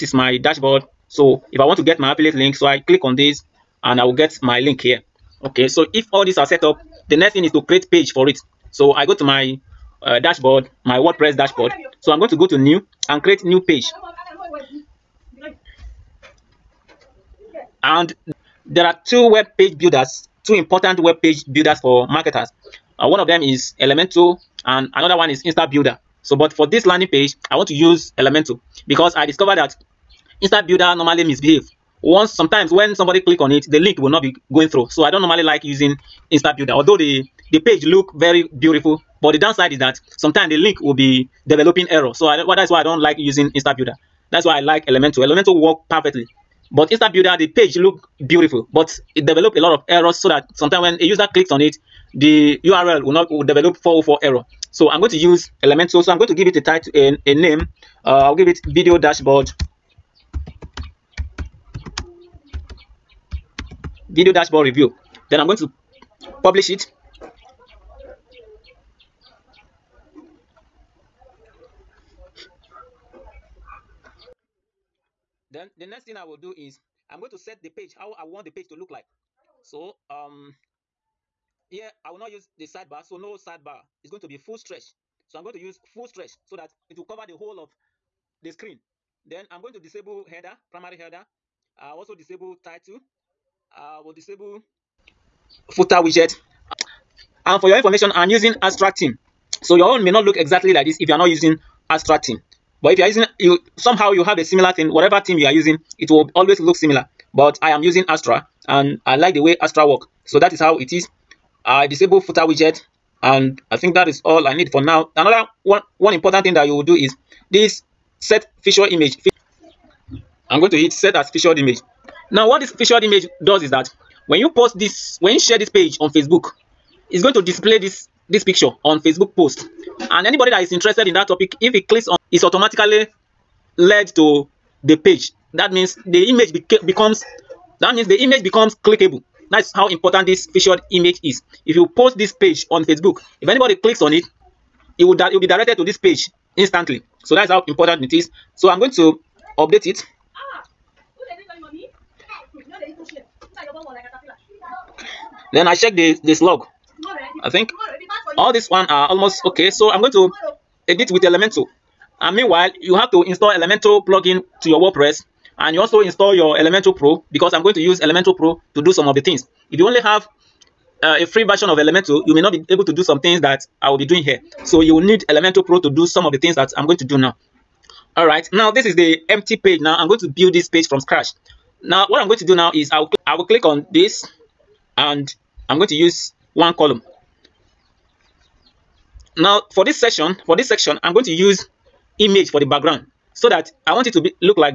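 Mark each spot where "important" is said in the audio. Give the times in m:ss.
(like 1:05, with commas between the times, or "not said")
0:20, 1:56, 2:19, 2:27.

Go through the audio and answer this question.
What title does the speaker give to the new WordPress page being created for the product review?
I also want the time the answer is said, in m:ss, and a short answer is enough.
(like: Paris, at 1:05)
video dashboard review, at 1:04.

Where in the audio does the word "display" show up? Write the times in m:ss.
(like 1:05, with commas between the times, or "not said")
2:07.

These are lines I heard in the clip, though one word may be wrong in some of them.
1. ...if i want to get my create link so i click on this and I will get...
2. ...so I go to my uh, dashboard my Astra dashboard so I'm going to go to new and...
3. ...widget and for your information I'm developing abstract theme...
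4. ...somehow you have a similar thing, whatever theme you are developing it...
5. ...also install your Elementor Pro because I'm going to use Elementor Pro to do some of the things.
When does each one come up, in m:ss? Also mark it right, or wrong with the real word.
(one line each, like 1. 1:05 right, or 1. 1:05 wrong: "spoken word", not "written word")
1. 0:01 wrong: "affiliate", not "create"
2. 0:08 wrong: "WordPress", not "Astra"
3. 1:36 wrong: "using", not "developing"
4. 1:43 wrong: "using", not "developing"
5. 2:45 right.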